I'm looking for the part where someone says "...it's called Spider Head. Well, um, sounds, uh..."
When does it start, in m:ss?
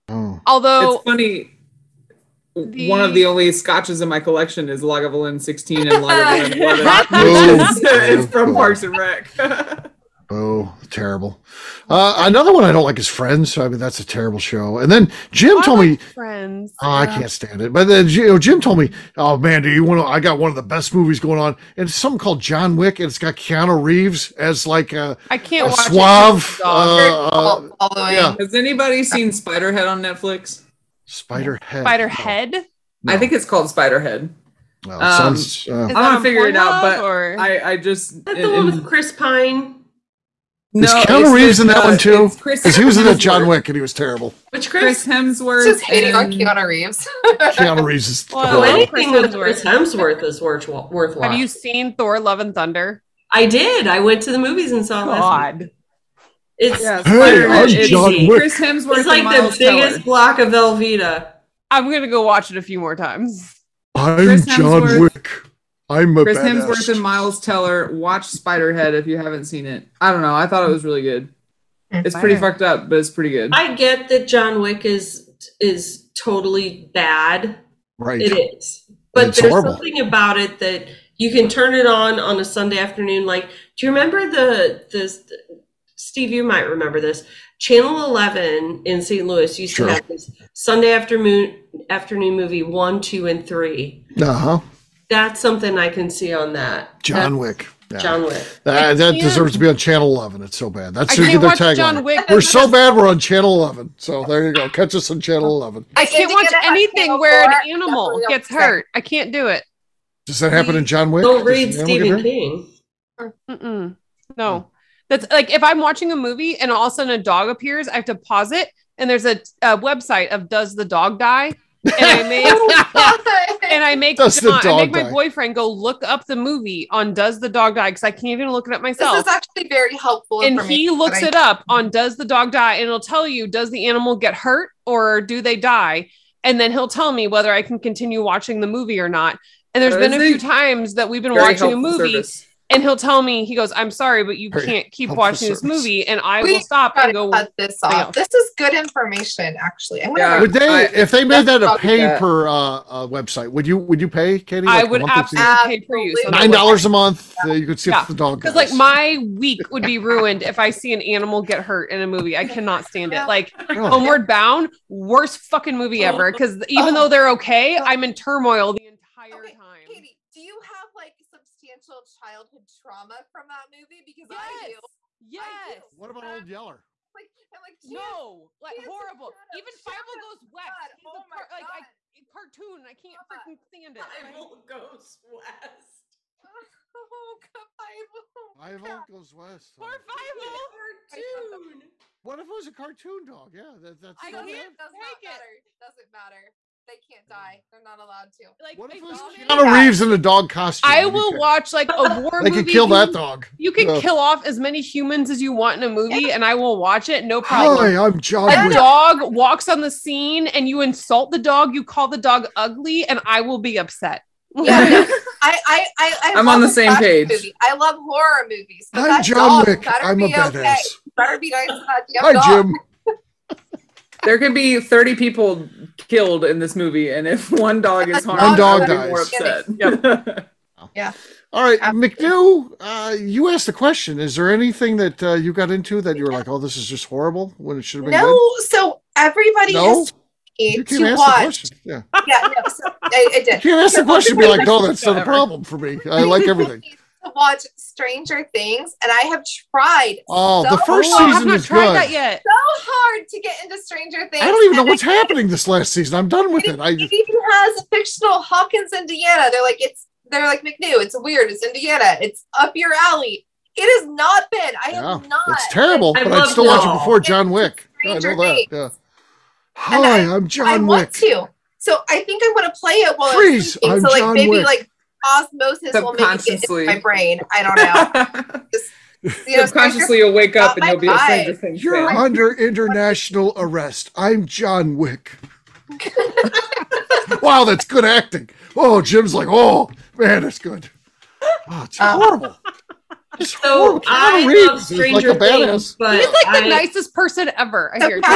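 0:33.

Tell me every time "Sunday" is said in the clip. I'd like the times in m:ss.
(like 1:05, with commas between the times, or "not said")
1:22, 1:30.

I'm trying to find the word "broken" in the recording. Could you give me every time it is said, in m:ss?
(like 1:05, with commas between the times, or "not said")
not said.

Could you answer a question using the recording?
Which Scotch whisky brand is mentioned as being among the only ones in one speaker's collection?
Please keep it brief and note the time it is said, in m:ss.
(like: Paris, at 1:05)
Lagavulin 16, at 0:04.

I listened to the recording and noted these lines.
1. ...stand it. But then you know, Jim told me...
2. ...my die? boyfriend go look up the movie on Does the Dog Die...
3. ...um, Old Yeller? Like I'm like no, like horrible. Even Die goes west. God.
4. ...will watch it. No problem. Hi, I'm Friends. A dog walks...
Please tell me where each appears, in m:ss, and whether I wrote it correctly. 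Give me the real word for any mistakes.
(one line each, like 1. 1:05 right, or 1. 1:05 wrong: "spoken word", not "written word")
1. 0:17 right
2. 2:04 right
3. 2:56 wrong: "Fievel", not "Die"
4. 3:26 wrong: "John", not "Friends".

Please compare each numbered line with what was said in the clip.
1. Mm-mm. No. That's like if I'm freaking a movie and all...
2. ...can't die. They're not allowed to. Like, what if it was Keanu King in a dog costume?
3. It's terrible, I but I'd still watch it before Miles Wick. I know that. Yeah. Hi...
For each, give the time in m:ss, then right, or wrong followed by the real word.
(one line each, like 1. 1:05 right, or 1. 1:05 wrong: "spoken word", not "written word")
1. 1:53 wrong: "watching", not "freaking"
2. 3:17 wrong: "Reeves", not "King"
3. 4:25 wrong: "John", not "Miles".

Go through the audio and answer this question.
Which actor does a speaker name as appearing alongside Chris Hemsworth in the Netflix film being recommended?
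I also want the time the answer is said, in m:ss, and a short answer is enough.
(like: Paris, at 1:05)
Miles Teller, at 1:07.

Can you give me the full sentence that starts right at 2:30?
would they I, if they made that a pay good.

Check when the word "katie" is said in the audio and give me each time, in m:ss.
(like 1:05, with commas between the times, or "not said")
2:34, 2:49.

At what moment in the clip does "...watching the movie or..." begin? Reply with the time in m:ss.
2:18.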